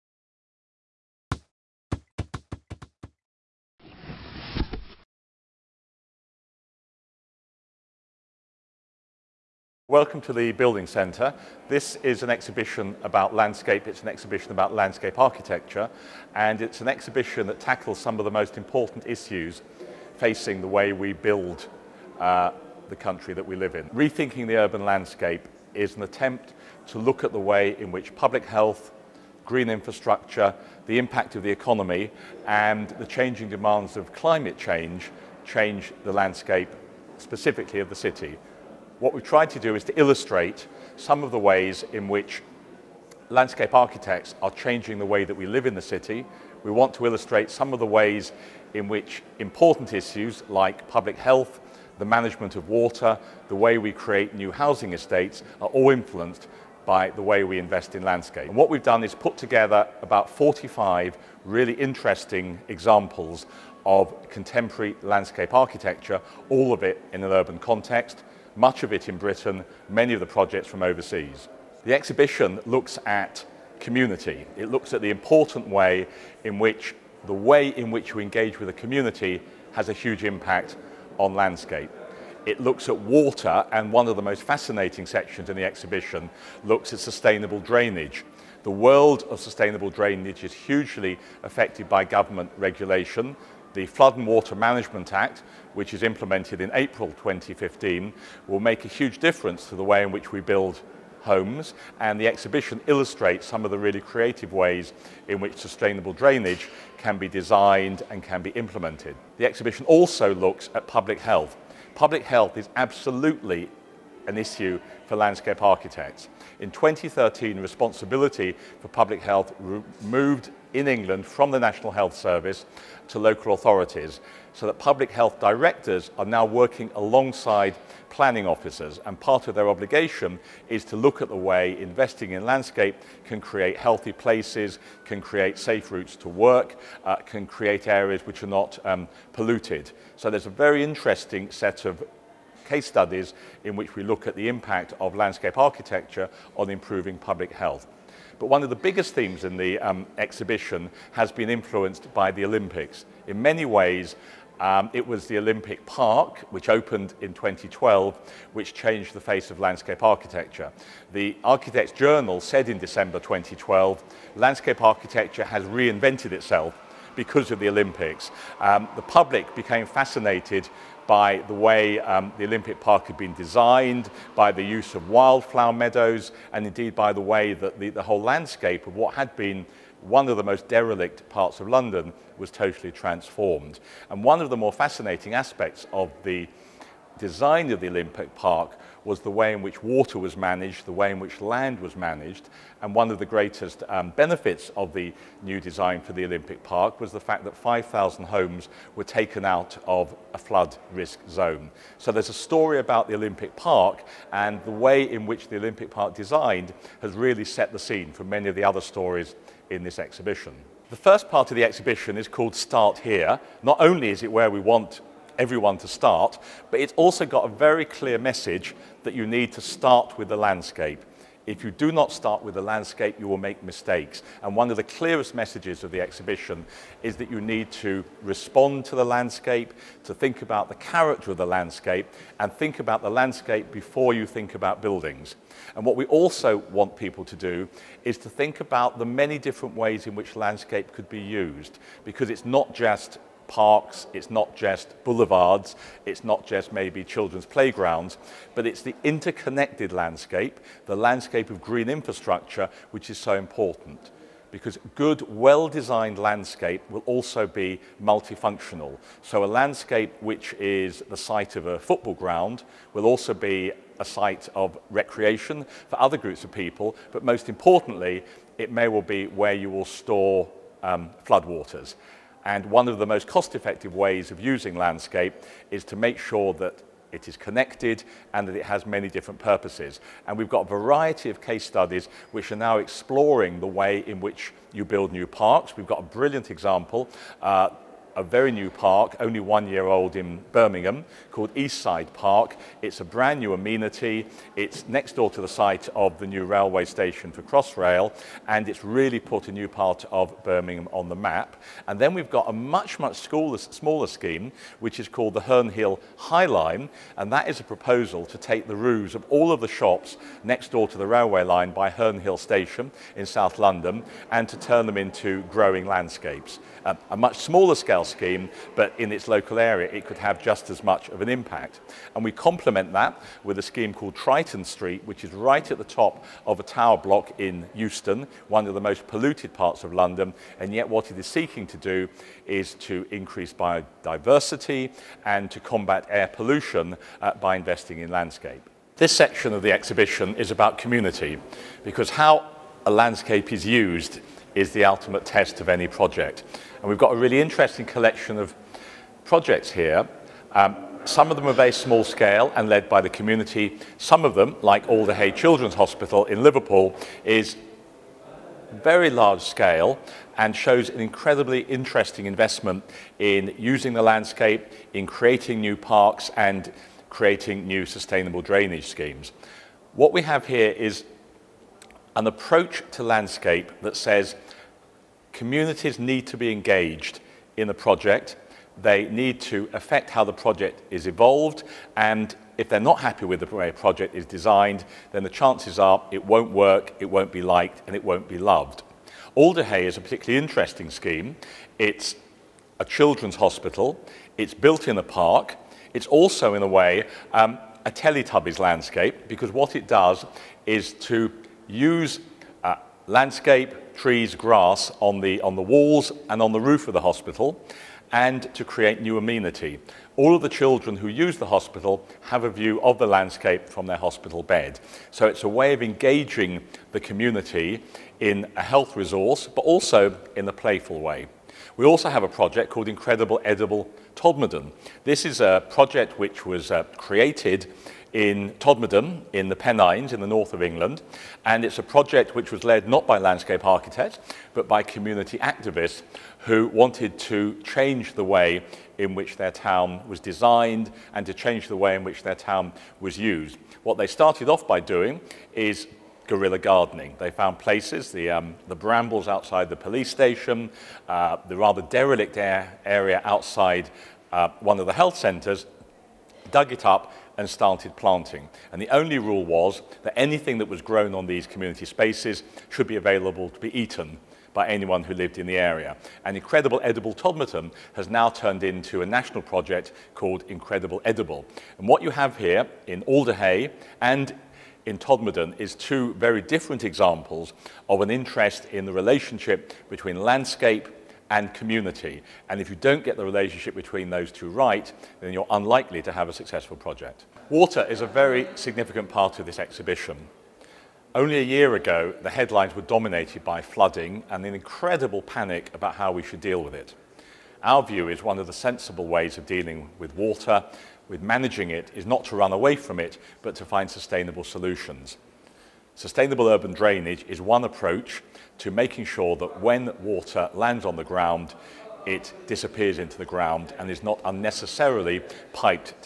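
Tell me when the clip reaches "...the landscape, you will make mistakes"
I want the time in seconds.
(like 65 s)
222 s.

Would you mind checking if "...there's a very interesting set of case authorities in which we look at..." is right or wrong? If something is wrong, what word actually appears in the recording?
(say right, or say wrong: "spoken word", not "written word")
wrong: "studies", not "authorities".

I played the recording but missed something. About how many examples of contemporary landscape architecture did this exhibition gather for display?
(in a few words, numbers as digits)
45.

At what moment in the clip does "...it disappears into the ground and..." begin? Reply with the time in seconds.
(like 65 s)
512 s.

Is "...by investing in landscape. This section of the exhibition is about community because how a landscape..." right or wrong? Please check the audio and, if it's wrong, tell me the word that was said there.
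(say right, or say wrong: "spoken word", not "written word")
right.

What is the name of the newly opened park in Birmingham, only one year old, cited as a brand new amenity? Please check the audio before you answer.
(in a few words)
Eastside Park.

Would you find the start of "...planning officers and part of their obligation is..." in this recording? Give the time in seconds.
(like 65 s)
128 s.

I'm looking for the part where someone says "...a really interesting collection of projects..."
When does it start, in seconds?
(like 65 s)
347 s.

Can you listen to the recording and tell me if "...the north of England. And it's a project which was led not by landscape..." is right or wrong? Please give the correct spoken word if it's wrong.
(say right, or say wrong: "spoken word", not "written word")
right.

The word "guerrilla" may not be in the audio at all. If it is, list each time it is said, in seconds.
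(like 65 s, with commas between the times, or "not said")
446 s.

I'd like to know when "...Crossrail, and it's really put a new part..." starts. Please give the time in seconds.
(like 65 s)
297 s.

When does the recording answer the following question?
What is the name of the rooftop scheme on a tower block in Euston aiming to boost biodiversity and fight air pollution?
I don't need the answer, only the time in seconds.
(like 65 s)
324 s.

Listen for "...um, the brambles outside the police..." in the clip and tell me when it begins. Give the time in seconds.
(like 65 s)
448 s.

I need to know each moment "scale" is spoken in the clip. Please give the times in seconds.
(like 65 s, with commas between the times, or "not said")
317 s, 352 s, 359 s.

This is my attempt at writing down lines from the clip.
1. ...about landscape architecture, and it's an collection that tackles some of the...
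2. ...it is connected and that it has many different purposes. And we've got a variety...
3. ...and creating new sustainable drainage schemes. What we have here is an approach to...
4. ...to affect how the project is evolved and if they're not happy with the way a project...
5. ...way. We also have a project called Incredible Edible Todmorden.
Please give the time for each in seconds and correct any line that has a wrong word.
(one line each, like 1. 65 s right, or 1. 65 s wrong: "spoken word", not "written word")
1. 14 s wrong: "exhibition", not "collection"
2. 277 s right
3. 366 s right
4. 379 s right
5. 421 s right.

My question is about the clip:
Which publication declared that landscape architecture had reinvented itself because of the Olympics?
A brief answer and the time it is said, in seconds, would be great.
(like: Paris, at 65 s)
The Architects Journal, at 161 s.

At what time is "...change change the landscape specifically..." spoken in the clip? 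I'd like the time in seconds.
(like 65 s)
34 s.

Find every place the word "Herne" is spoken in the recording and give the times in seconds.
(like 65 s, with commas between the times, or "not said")
305 s, 311 s.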